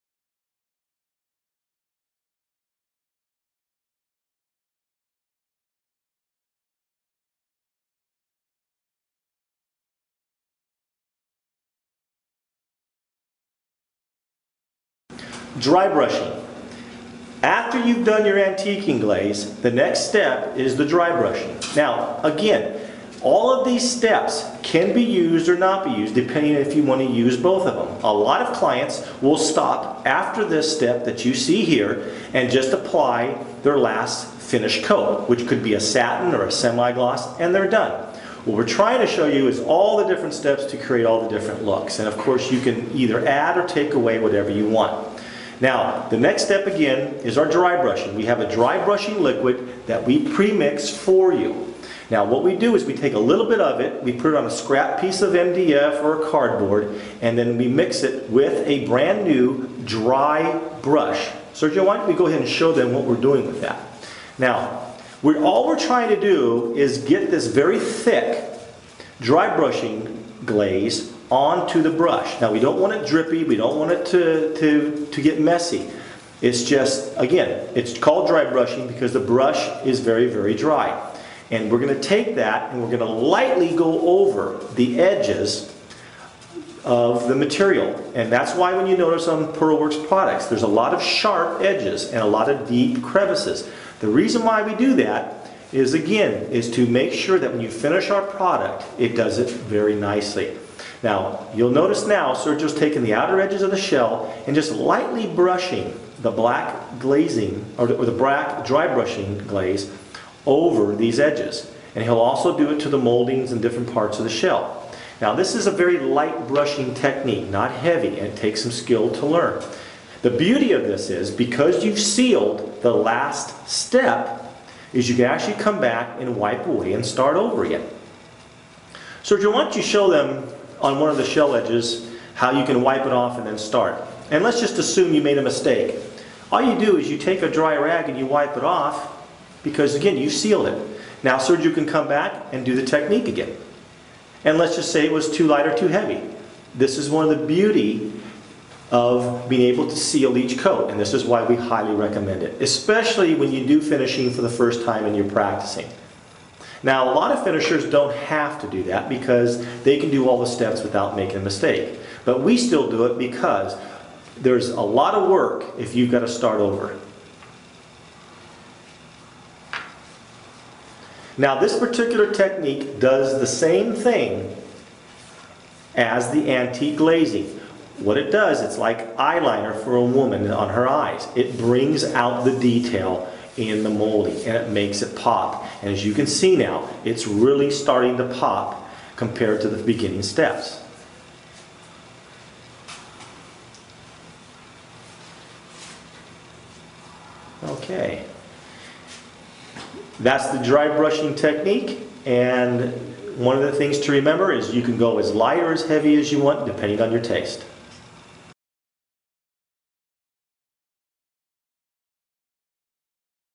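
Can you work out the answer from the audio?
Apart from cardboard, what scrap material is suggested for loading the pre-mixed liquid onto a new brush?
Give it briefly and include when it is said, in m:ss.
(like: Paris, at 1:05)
MDF, at 0:55.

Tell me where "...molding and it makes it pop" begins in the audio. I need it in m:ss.
3:03.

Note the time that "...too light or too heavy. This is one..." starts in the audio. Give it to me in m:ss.
2:25.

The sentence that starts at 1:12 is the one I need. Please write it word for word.
Now we don't want it drippy, we don't want it to, to, to get messy.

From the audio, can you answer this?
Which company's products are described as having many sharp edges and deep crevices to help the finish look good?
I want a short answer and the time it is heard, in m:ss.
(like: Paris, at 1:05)
PearlWorks, at 1:29.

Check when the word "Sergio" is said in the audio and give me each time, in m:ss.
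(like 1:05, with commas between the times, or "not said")
1:01, 1:42, 2:09, 2:21.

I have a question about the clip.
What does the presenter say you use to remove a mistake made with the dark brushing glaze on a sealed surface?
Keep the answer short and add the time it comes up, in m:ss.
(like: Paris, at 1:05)
a dry rag, at 2:17.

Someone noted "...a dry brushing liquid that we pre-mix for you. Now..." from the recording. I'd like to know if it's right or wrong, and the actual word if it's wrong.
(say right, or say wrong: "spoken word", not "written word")
right.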